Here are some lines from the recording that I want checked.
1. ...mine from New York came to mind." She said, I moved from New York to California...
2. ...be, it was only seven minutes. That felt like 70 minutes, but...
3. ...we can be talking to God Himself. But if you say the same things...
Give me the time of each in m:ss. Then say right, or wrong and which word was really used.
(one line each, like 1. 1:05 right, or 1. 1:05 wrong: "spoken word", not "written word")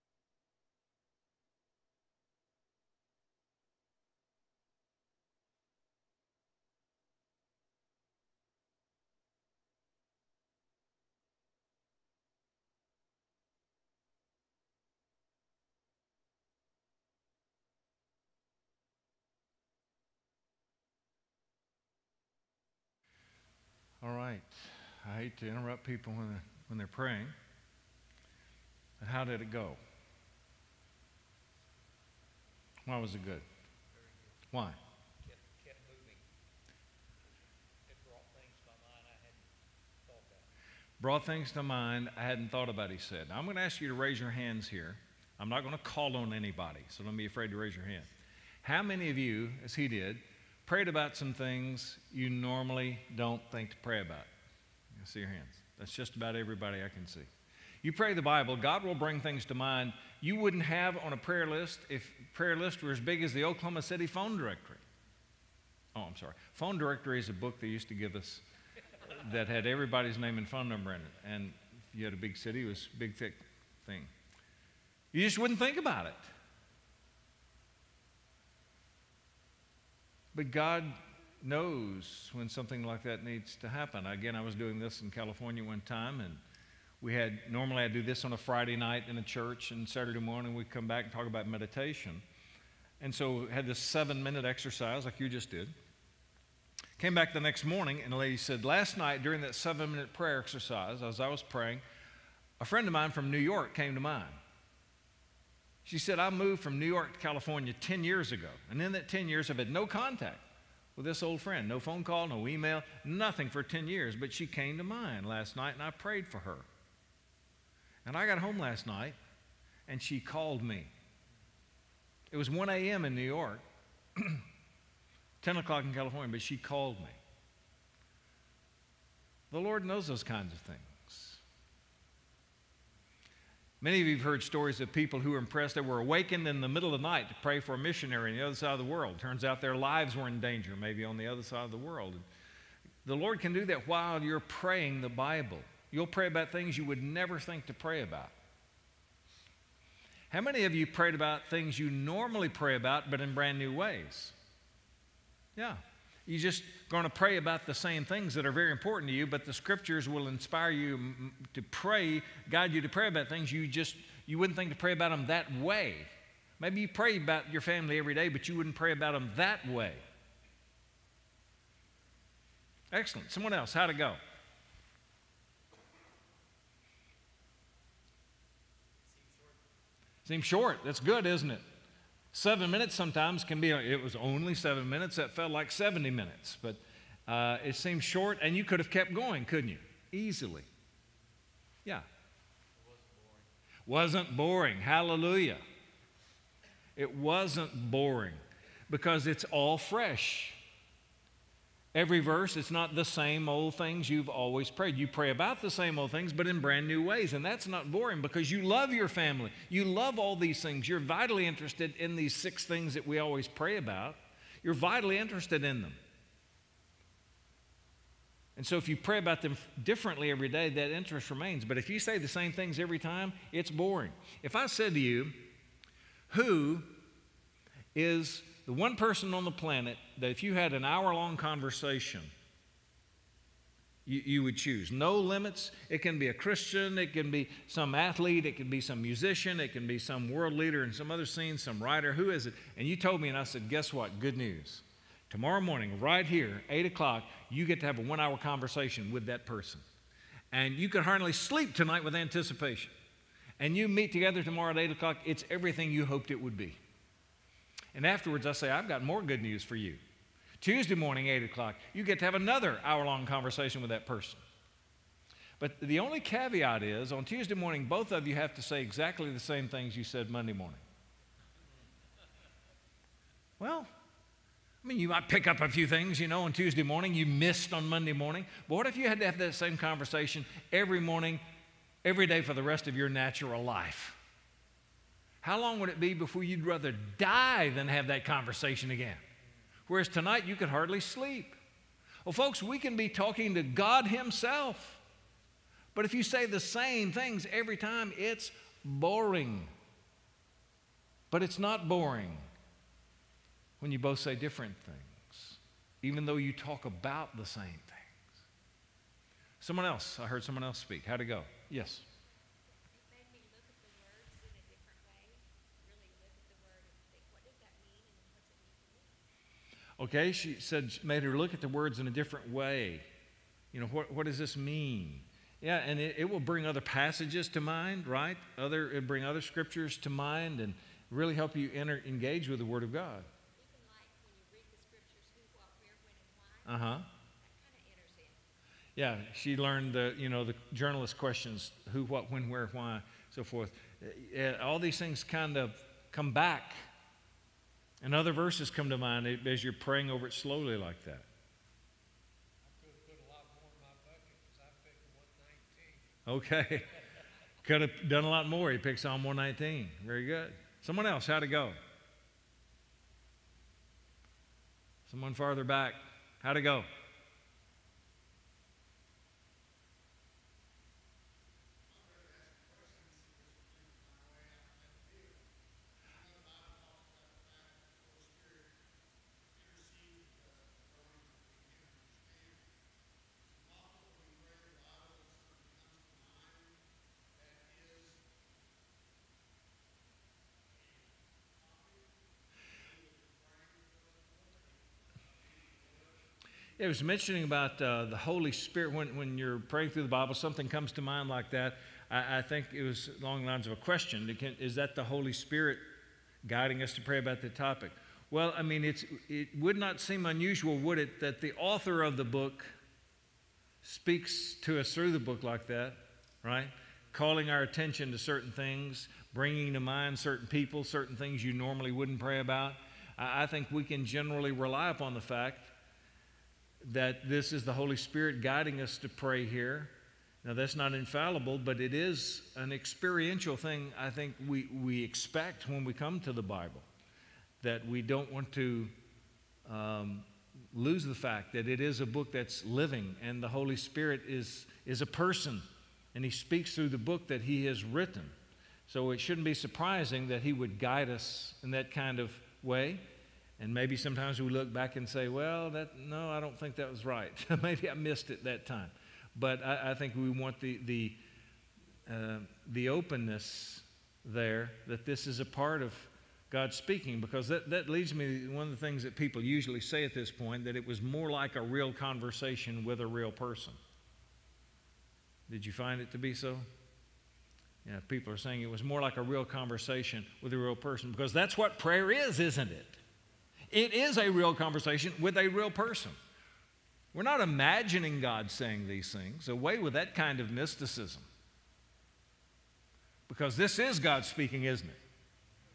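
1. 1:42 right
2. 3:03 right
3. 4:52 right.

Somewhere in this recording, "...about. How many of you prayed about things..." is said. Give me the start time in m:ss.
2:28.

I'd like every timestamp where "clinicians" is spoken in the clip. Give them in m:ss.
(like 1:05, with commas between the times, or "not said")
not said.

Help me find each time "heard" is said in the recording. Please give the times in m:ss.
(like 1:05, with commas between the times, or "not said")
2:14, 5:10.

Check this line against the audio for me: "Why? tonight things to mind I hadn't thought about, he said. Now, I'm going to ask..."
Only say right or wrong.
wrong.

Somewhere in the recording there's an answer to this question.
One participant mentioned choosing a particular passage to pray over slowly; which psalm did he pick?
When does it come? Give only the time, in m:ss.
5:59.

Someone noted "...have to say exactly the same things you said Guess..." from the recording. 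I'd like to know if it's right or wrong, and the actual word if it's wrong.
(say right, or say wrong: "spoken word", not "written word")
wrong: "Monday", not "Guess".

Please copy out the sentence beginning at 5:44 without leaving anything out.
Uh, all these things kind of come back and other verses come to mind as you're praying over it slowly like that.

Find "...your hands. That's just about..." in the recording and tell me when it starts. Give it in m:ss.
0:55.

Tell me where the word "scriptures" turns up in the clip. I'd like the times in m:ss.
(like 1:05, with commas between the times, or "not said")
2:39, 5:29.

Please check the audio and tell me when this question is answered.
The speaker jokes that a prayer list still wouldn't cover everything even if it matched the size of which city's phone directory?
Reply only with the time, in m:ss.
1:03.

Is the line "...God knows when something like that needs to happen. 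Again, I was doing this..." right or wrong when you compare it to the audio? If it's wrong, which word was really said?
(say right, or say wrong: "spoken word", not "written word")
right.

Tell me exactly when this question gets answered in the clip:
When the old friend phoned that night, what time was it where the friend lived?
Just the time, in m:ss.
2:02.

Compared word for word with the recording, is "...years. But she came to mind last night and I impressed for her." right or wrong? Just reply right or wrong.
wrong.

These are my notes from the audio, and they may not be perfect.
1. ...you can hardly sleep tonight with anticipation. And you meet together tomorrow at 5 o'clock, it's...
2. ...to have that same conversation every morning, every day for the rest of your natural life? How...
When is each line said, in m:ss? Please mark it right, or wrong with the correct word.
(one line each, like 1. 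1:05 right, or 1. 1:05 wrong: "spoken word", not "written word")
1. 4:10 wrong: "8", not "5"
2. 4:39 right.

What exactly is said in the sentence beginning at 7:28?
So it shouldn't be surprising that He would guide us in that kind of way.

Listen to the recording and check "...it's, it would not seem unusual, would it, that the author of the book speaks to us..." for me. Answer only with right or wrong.
right.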